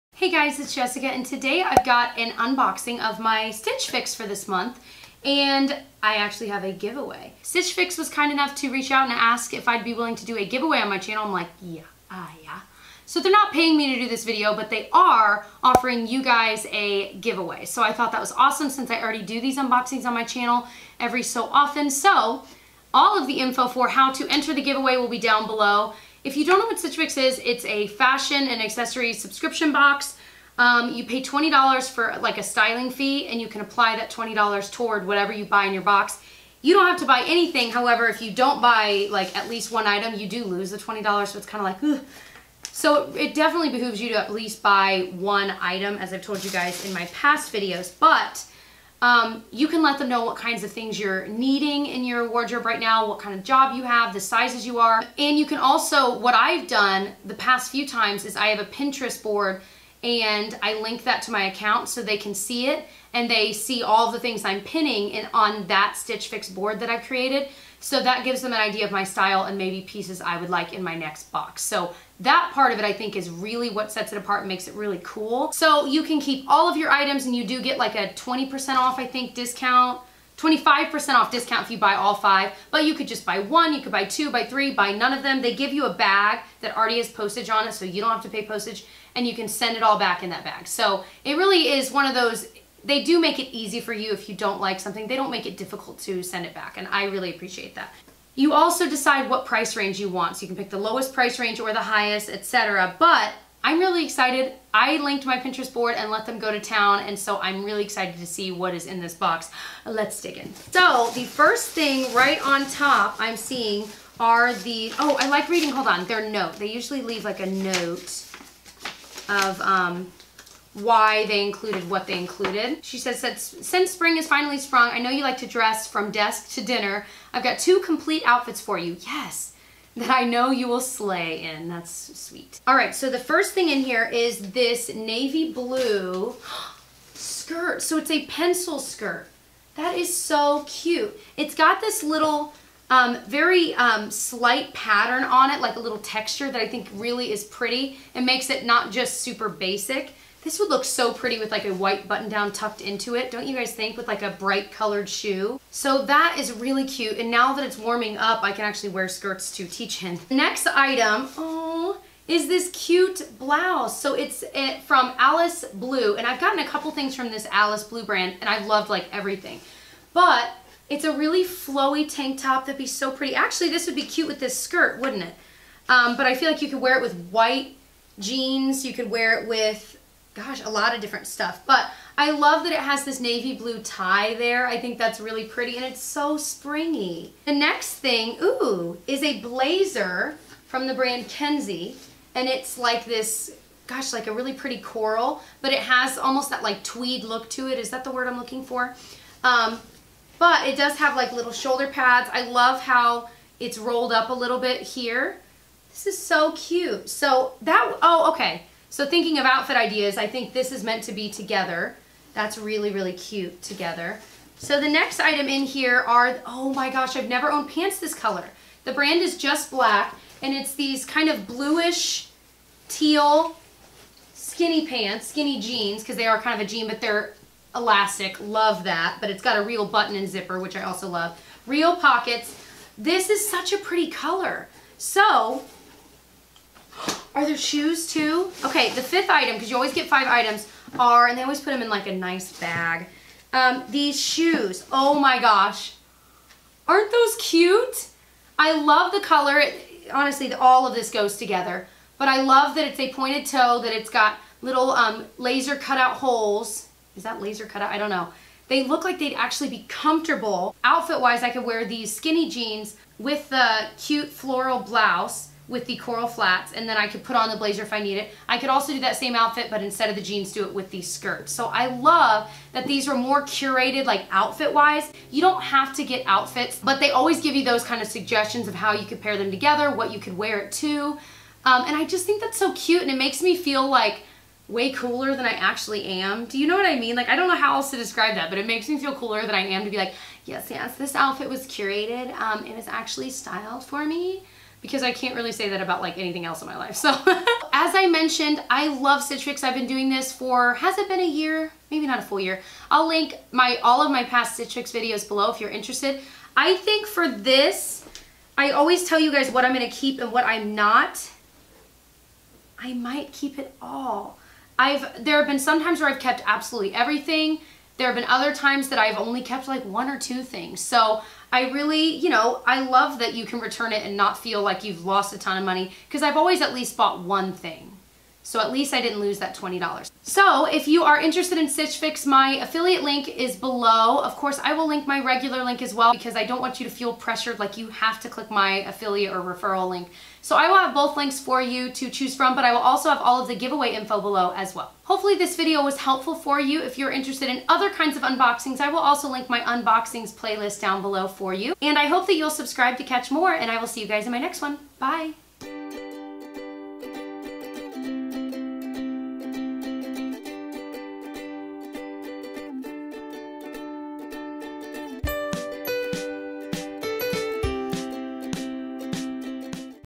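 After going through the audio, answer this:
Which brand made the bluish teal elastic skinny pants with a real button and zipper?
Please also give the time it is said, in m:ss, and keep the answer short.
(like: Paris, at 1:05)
Just Black, at 3:39.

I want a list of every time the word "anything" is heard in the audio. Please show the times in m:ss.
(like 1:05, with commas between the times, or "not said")
0:37, 4:56.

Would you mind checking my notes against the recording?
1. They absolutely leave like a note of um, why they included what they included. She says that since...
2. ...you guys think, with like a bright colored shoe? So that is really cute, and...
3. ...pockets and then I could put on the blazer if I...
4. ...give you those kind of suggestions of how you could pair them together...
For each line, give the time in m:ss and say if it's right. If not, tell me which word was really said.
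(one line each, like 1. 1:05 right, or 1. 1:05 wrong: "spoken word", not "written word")
1. 1:56 wrong: "usually", not "absolutely"
2. 2:33 right
3. 4:26 wrong: "flats", not "pockets"
4. 4:37 right.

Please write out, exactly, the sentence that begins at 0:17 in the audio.
So I thought that was awesome since I already do these unboxings on my channel every so often.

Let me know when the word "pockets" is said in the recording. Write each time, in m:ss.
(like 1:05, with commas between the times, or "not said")
3:51.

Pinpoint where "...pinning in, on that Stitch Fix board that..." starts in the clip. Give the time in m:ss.
1:04.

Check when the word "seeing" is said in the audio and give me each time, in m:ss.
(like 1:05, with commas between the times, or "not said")
1:53.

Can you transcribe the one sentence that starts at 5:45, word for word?
Hopefully this video was helpful for you.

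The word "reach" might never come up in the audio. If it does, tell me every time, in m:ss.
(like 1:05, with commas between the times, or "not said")
0:08.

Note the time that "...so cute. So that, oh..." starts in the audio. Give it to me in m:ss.
3:26.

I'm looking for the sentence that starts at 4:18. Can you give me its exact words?
They look like they'd actually be comfortable.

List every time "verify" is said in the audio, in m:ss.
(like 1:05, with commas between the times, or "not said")
not said.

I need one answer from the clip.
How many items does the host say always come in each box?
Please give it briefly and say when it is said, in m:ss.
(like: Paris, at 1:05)
5, at 4:00.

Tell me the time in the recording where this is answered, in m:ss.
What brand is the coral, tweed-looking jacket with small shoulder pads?
3:11.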